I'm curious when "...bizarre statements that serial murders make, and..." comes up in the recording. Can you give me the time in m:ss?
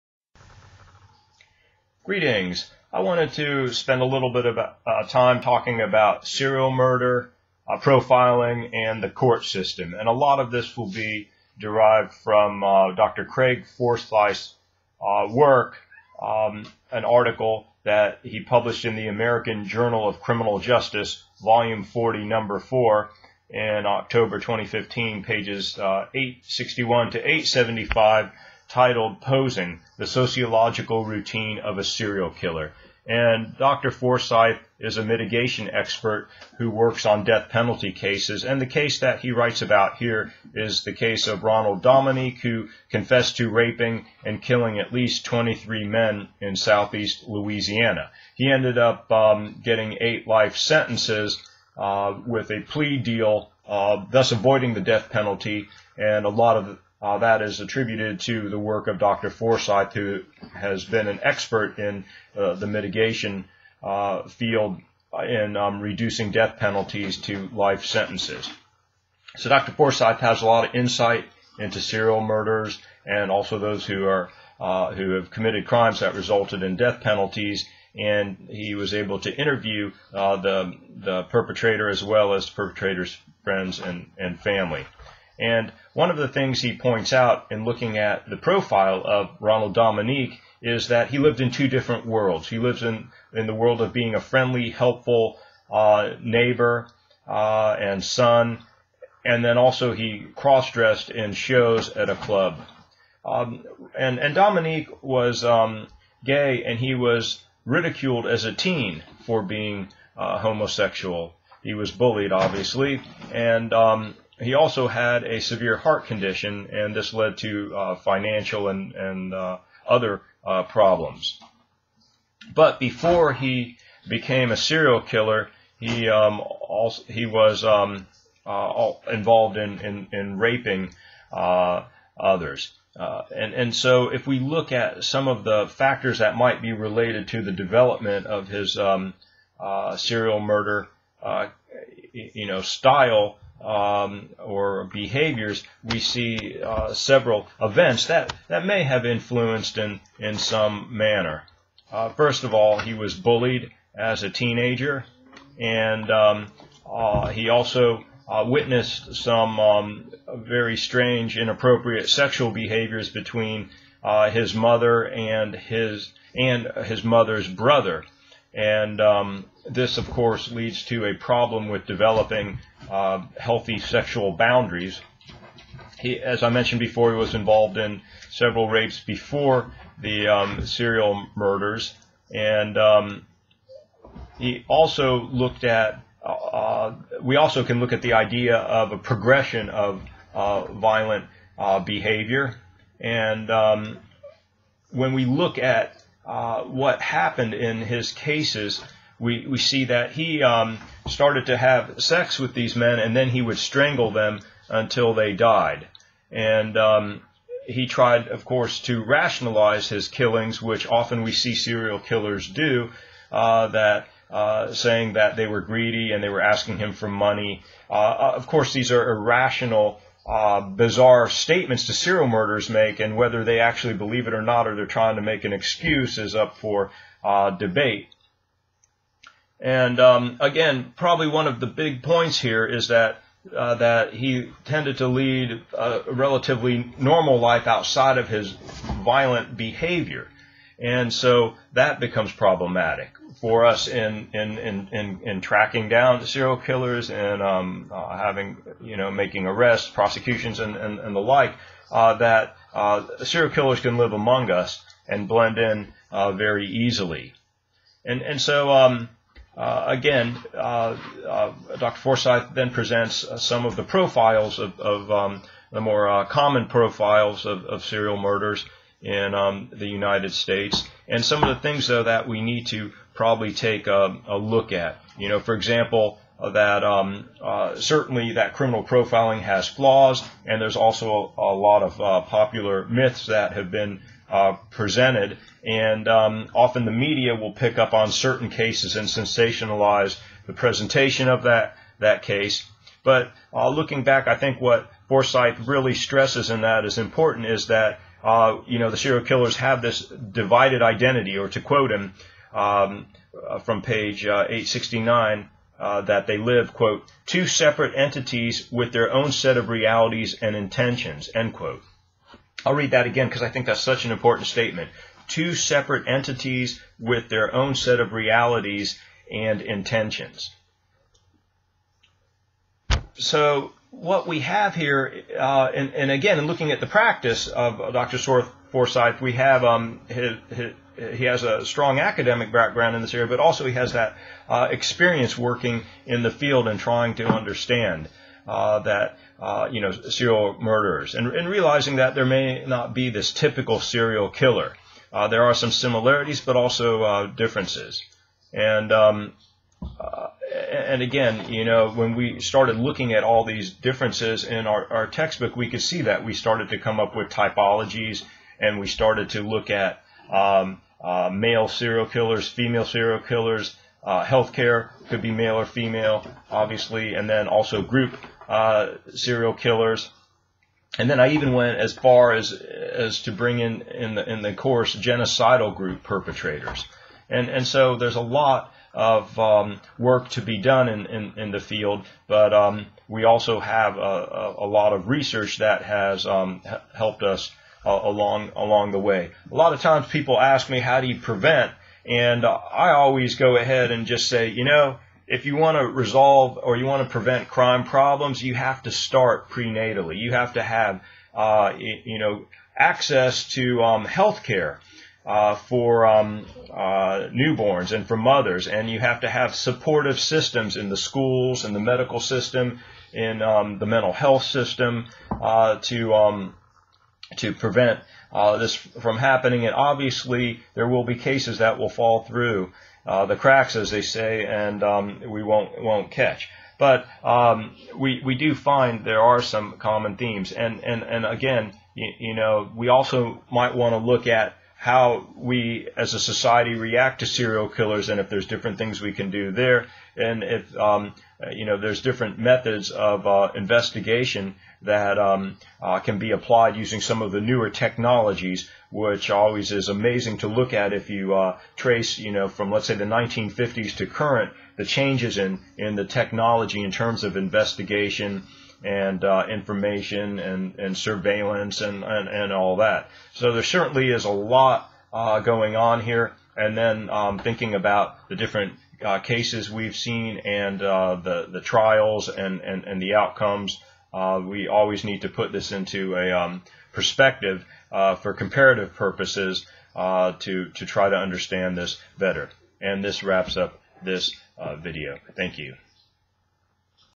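3:40.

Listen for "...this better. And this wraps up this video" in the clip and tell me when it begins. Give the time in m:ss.
8:01.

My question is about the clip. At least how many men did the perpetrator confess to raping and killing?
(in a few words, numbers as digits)
23.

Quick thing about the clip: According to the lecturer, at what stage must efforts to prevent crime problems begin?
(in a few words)
prenatally.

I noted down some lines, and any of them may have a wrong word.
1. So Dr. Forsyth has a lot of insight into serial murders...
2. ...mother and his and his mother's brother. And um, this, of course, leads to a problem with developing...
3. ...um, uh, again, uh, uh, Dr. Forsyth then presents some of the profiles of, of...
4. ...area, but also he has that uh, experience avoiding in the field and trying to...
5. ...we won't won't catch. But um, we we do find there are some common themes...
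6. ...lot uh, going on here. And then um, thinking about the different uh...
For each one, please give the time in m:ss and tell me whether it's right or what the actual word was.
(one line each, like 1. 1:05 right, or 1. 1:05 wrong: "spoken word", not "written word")
1. 1:09 right
2. 2:44 right
3. 4:18 right
4. 5:33 wrong: "working", not "avoiding"
5. 7:05 right
6. 7:44 right.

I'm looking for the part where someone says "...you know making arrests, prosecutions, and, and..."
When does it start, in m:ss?
4:08.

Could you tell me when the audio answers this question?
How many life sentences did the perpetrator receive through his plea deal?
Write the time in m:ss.
0:49.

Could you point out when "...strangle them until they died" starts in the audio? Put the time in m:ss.
3:23.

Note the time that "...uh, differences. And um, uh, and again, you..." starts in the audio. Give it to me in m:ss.
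5:47.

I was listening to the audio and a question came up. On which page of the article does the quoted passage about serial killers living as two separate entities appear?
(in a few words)
869.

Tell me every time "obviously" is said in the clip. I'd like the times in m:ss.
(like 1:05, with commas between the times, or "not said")
1:52, 6:06, 6:59.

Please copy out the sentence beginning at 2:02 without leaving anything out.
But before he became a serial killer, he um, also he was um, uh, involved in in, in raping uh, others.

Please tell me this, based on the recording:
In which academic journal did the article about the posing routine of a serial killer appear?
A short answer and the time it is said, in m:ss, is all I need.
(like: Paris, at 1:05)
American Journal of Criminal Justice, at 0:19.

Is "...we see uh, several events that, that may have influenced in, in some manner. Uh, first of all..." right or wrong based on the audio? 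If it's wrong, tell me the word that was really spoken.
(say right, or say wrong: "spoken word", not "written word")
right.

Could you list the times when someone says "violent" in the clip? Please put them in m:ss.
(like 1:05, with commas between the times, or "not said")
3:10, 3:59.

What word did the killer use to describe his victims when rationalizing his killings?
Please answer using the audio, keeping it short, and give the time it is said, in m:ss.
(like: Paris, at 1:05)
greedy, at 3:35.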